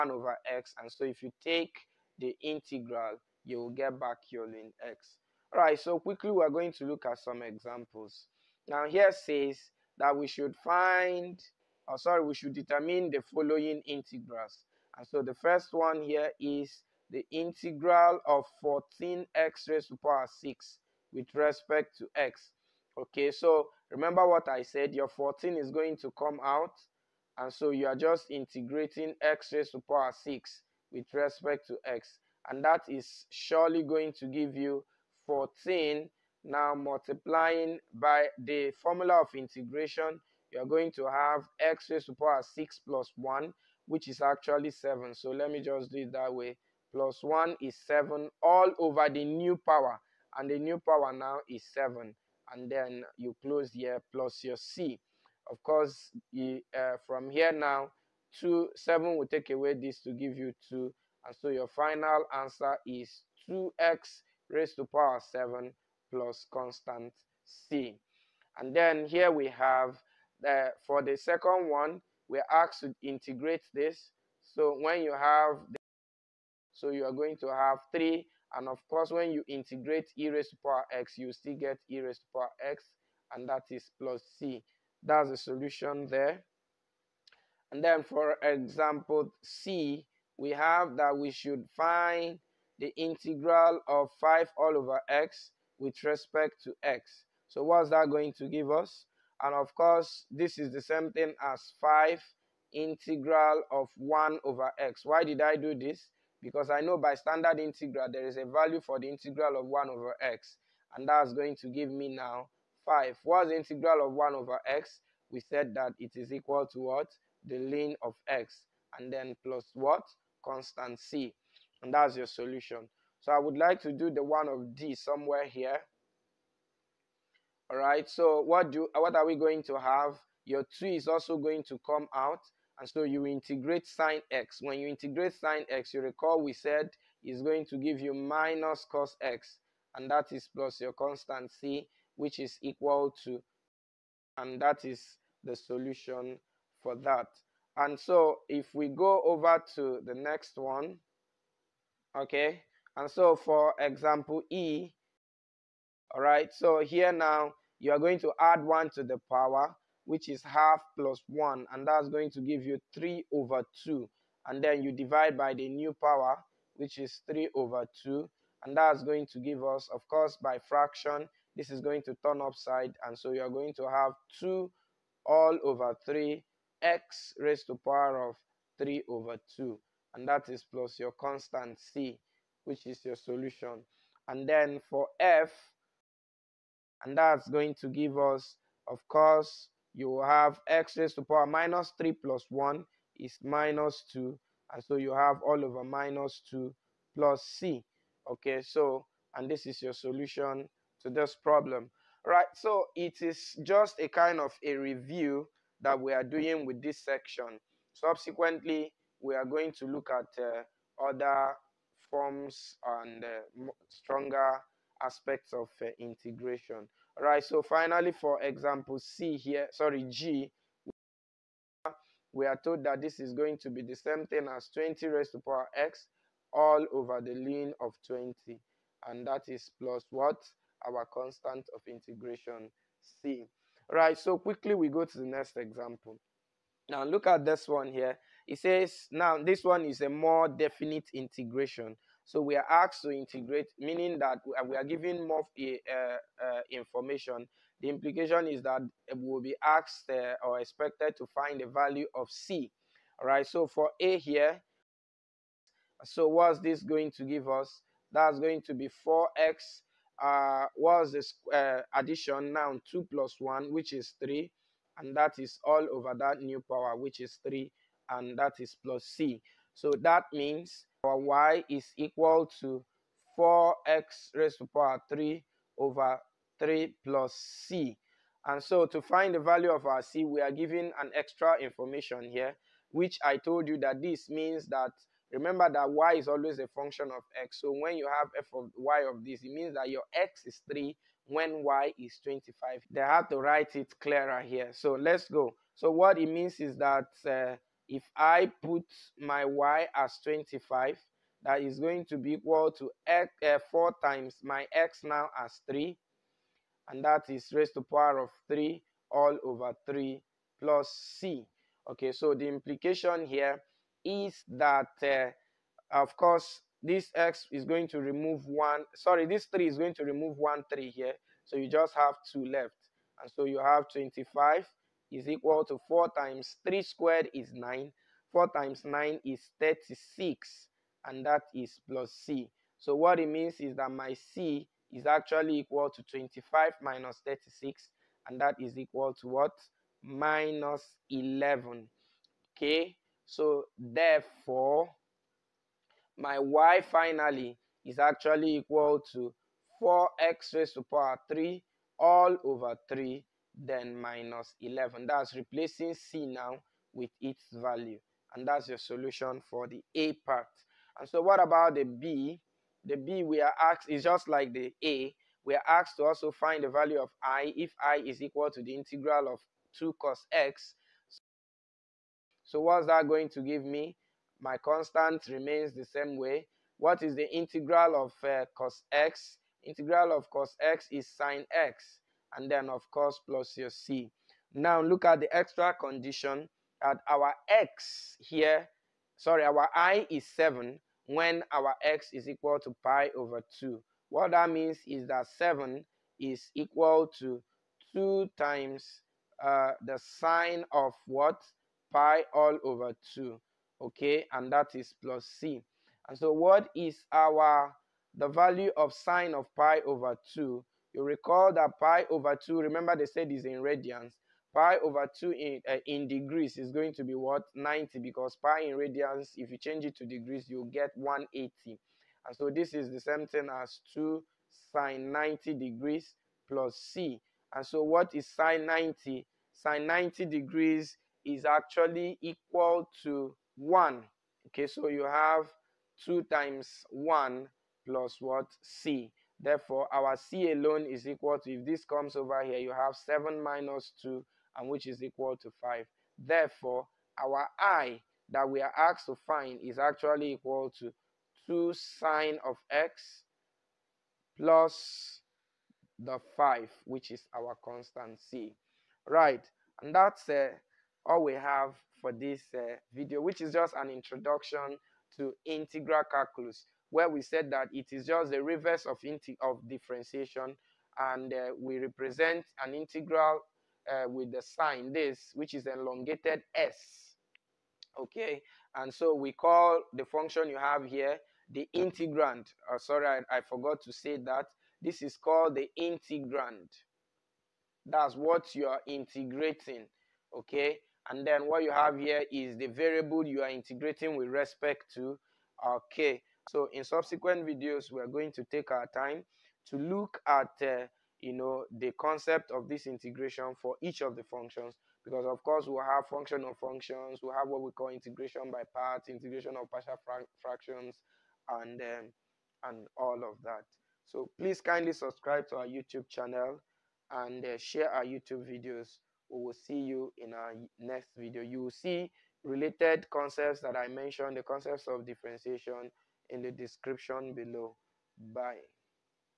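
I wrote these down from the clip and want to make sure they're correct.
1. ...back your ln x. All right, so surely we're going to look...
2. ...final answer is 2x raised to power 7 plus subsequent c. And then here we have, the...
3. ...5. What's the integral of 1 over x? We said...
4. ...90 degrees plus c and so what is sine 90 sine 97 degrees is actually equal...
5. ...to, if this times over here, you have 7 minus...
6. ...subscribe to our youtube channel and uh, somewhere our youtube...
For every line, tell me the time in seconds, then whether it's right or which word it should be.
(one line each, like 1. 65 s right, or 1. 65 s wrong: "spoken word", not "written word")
1. 3 s wrong: "quickly", not "surely"
2. 61 s wrong: "constant", not "subsequent"
3. 112 s right
4. 425 s wrong: "90", not "97"
5. 441 s wrong: "comes", not "times"
6. 514 s wrong: "share", not "somewhere".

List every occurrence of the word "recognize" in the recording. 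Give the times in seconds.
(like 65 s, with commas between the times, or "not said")
not said.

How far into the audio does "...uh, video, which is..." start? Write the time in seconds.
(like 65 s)
462 s.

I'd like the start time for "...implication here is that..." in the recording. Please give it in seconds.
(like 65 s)
312 s.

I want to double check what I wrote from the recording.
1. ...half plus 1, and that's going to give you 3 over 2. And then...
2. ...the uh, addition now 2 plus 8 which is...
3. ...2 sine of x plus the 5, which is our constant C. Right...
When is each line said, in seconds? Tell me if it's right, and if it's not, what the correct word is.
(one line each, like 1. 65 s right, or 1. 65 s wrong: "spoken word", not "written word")
1. 160 s right
2. 261 s wrong: "1", not "8"
3. 451 s right.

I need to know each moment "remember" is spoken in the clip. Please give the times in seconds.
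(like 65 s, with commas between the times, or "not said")
23 s, 285 s, 412 s.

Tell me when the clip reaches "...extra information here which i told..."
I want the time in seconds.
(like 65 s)
281 s.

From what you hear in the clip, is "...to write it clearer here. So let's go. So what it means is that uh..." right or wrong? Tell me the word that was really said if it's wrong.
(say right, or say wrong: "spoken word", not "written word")
right.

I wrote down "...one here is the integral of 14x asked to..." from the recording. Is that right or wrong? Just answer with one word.
wrong.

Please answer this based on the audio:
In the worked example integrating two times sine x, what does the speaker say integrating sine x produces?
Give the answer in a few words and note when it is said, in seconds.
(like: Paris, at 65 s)
minus cos x, at 138 s.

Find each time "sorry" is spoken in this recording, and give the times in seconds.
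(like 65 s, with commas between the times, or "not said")
11 s, 219 s, 318 s, 389 s, 482 s.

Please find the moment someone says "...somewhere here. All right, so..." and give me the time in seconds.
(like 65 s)
124 s.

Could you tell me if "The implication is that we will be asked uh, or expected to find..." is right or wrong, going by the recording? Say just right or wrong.
right.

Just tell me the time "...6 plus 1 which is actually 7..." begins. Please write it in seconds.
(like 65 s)
42 s.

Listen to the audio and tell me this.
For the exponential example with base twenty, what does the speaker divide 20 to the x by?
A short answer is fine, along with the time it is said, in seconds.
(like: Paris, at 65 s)
ln of 20, at 227 s.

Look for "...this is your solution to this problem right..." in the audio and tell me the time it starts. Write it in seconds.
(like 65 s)
199 s.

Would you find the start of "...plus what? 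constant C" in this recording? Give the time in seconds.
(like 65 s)
119 s.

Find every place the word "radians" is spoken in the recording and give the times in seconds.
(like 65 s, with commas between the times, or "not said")
413 s, 418 s.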